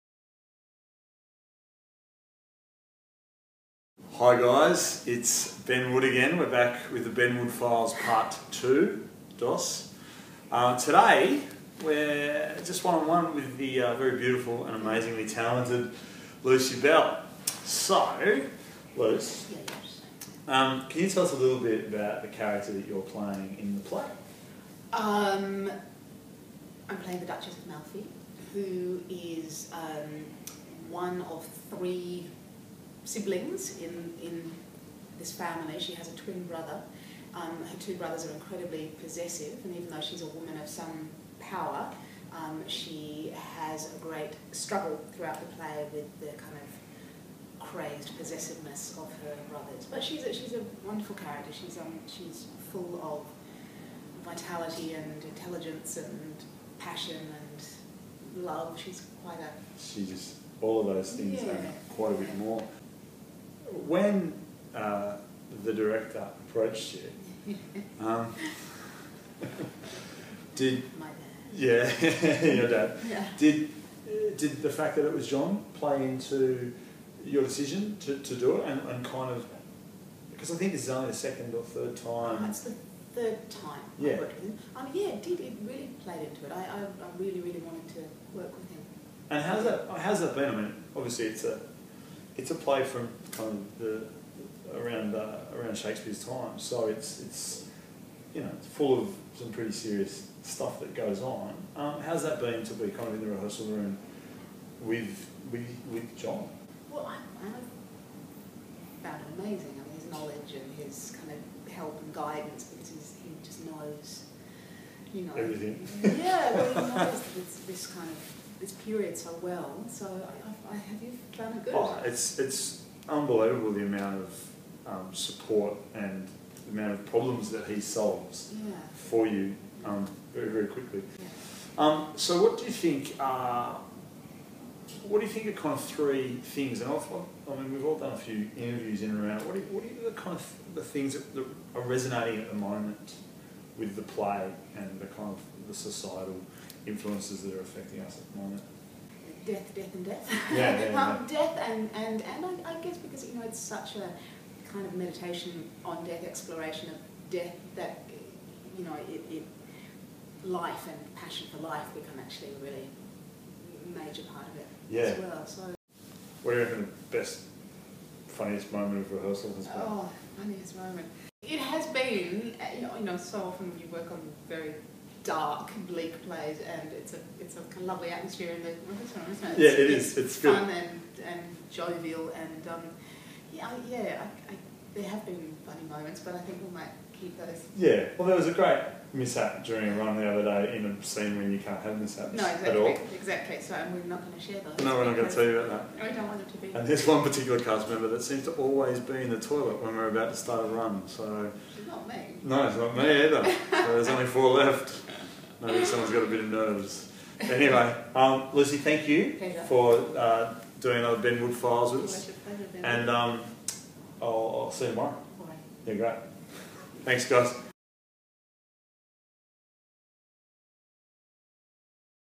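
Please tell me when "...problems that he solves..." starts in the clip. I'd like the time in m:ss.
2:07.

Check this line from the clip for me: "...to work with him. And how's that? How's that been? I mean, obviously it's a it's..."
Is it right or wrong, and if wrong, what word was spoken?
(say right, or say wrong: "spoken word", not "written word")
right.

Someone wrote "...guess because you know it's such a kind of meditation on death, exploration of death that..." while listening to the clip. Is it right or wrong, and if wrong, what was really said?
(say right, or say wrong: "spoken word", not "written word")
right.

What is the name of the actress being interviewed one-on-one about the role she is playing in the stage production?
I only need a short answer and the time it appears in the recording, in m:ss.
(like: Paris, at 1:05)
Lucy Bell, at 0:16.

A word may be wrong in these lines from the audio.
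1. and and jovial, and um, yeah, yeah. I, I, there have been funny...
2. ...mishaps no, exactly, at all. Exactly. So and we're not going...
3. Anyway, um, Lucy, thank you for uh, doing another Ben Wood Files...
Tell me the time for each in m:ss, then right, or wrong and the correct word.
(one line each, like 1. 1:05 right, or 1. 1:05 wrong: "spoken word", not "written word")
1. 3:00 right
2. 3:11 right
3. 3:27 right.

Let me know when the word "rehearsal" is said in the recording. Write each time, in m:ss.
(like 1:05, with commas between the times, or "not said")
1:43, 2:49.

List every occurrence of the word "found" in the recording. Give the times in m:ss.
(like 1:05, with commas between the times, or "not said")
1:49, 2:01.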